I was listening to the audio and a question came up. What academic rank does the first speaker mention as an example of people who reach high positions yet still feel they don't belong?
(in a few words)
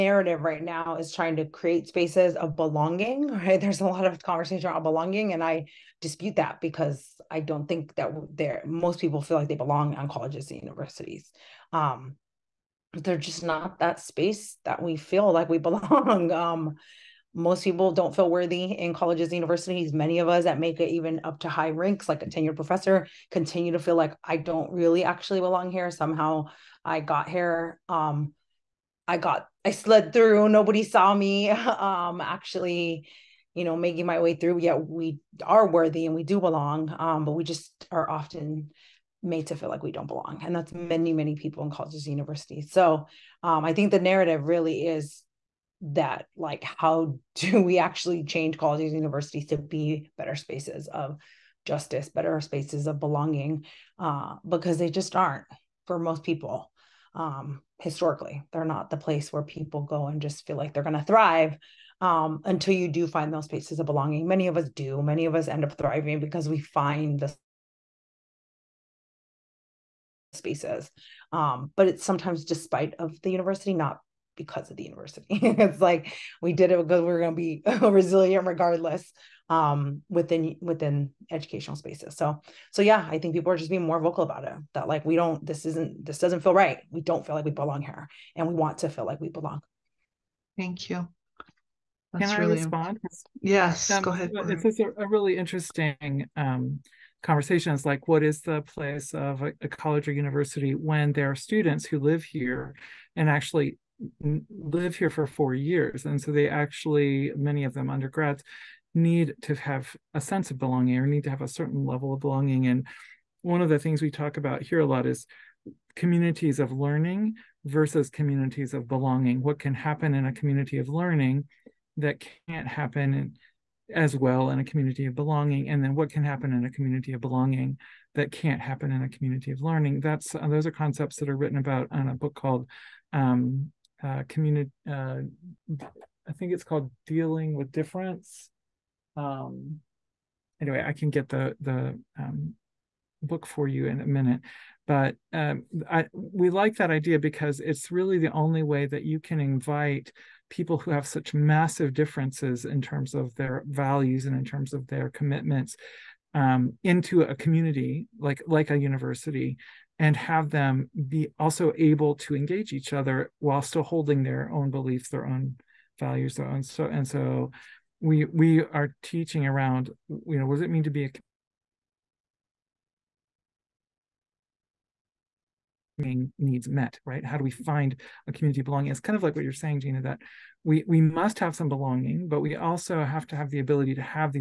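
tenured professor.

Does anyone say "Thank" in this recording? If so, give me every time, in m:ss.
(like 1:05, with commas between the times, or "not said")
1:30.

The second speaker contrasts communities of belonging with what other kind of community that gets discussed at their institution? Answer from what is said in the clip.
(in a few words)
communities of learning.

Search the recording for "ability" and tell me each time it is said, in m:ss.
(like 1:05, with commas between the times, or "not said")
3:03.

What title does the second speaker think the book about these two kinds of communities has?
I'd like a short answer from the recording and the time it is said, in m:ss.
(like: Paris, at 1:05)
Dealing with Difference, at 2:17.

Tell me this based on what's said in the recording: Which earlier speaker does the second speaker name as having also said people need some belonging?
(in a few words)
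Gina.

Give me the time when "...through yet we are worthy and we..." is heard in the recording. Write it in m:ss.
0:34.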